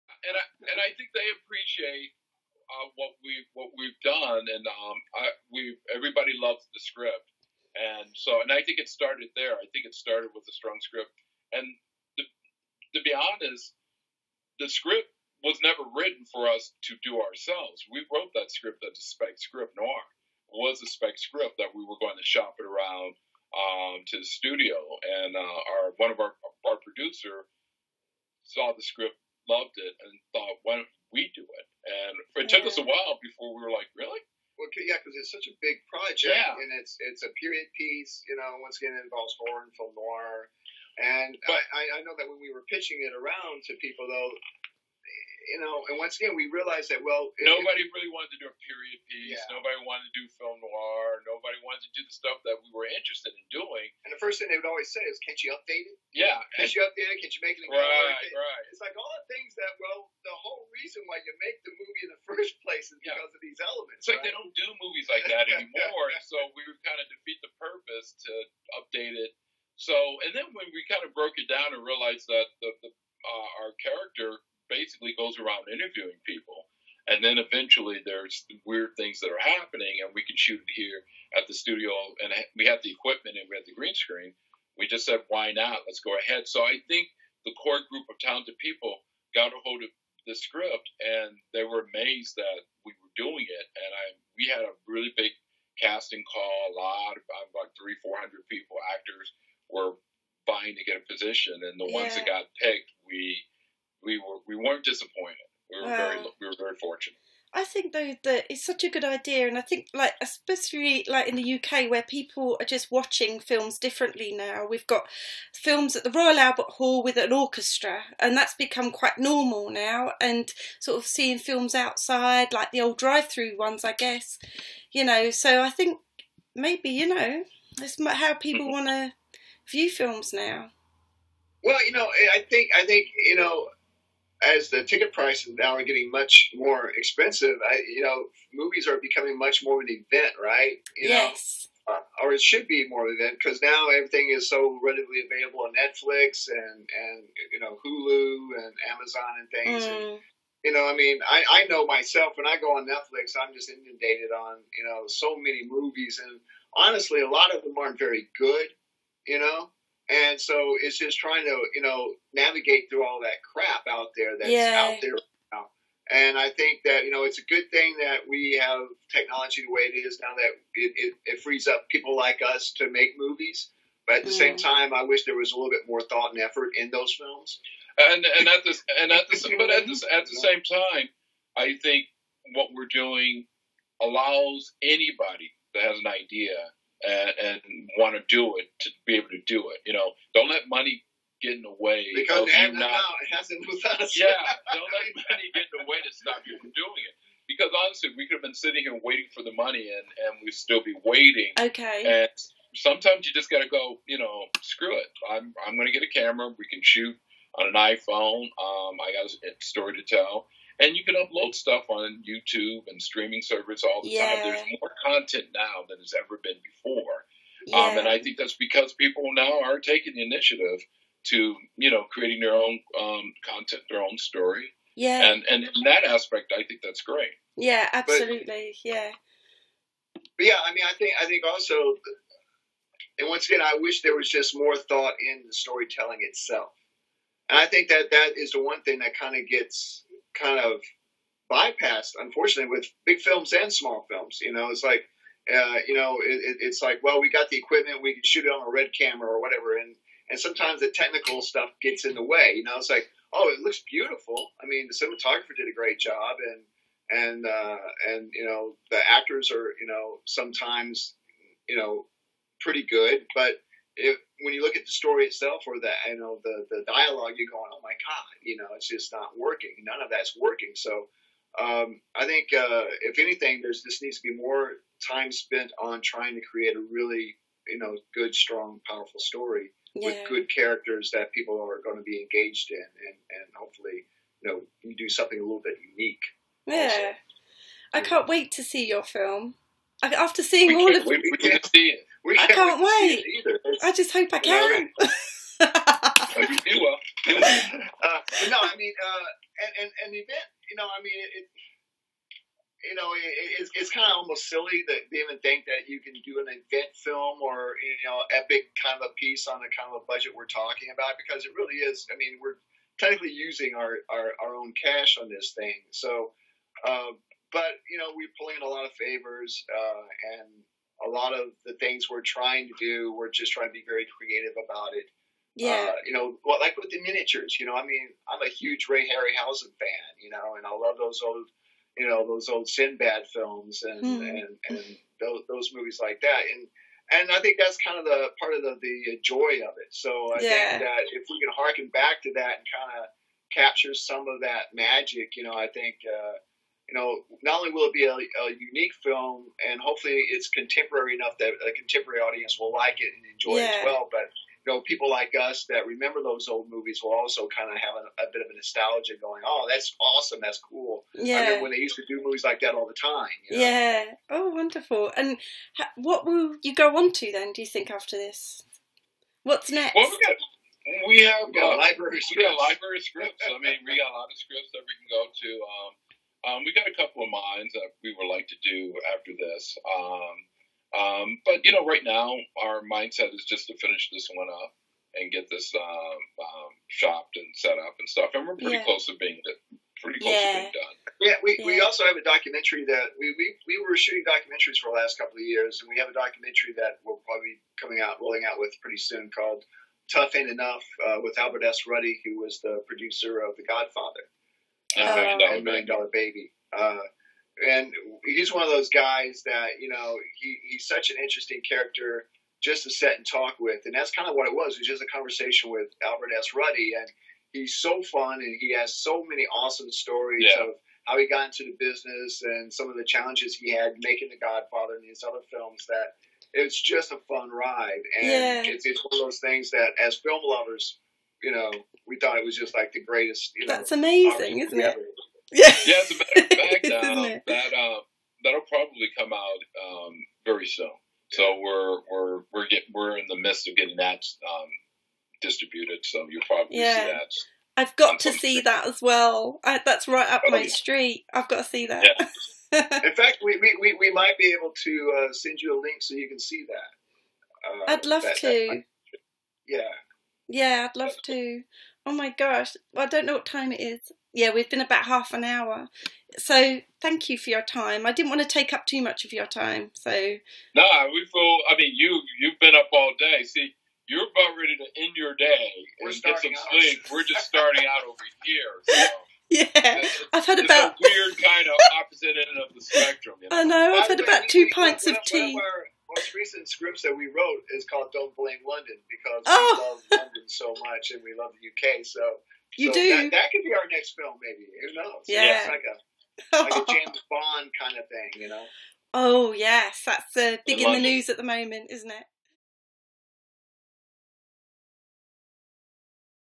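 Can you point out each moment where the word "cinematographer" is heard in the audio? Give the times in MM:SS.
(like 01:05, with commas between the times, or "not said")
04:14.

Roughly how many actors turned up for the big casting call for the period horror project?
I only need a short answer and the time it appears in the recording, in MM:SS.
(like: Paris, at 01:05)
300 to 400, at 01:37.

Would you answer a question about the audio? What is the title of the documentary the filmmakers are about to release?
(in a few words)
Tough Ain't Enough.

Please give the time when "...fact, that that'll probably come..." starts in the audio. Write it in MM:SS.
07:17.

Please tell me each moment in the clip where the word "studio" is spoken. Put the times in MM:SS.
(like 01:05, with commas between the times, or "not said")
00:24, 01:21.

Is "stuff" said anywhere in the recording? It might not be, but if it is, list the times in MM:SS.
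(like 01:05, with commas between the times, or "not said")
00:52, 03:31, 04:11, 06:28.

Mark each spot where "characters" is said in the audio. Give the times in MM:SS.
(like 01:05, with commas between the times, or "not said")
04:40, 06:51.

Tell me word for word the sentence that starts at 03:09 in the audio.
You know, don't let money get in the way because of you not.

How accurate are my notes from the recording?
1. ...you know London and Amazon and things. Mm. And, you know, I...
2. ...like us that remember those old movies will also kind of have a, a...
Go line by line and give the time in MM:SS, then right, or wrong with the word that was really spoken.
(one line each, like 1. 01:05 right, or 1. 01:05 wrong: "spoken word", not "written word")
1. 02:27 wrong: "Hulu", not "London"
2. 05:55 right.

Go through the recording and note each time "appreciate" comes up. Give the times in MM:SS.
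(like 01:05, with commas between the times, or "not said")
00:01.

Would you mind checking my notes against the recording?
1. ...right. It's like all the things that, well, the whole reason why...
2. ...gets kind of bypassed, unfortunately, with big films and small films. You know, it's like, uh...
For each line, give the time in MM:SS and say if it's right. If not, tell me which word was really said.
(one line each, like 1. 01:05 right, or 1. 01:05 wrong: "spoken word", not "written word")
1. 00:57 right
2. 03:59 right.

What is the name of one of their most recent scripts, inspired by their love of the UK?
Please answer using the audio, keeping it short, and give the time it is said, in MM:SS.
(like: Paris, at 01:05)
Don't Blame London, at 08:08.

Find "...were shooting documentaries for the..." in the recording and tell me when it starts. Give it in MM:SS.
06:33.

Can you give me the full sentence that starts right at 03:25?
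I'm I'm going to get a camera.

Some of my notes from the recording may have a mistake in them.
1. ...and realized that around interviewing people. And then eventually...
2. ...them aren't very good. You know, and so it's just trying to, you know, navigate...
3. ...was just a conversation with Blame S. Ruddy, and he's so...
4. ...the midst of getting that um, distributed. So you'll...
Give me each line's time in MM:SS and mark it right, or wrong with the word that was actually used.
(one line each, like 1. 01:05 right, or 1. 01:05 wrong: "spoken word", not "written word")
1. 01:11 right
2. 02:37 right
3. 06:54 wrong: "Albert", not "Blame"
4. 07:23 right.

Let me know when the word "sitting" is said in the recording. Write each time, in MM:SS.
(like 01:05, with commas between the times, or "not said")
03:18.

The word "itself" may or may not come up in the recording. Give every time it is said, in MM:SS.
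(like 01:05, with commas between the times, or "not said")
03:56, 04:25.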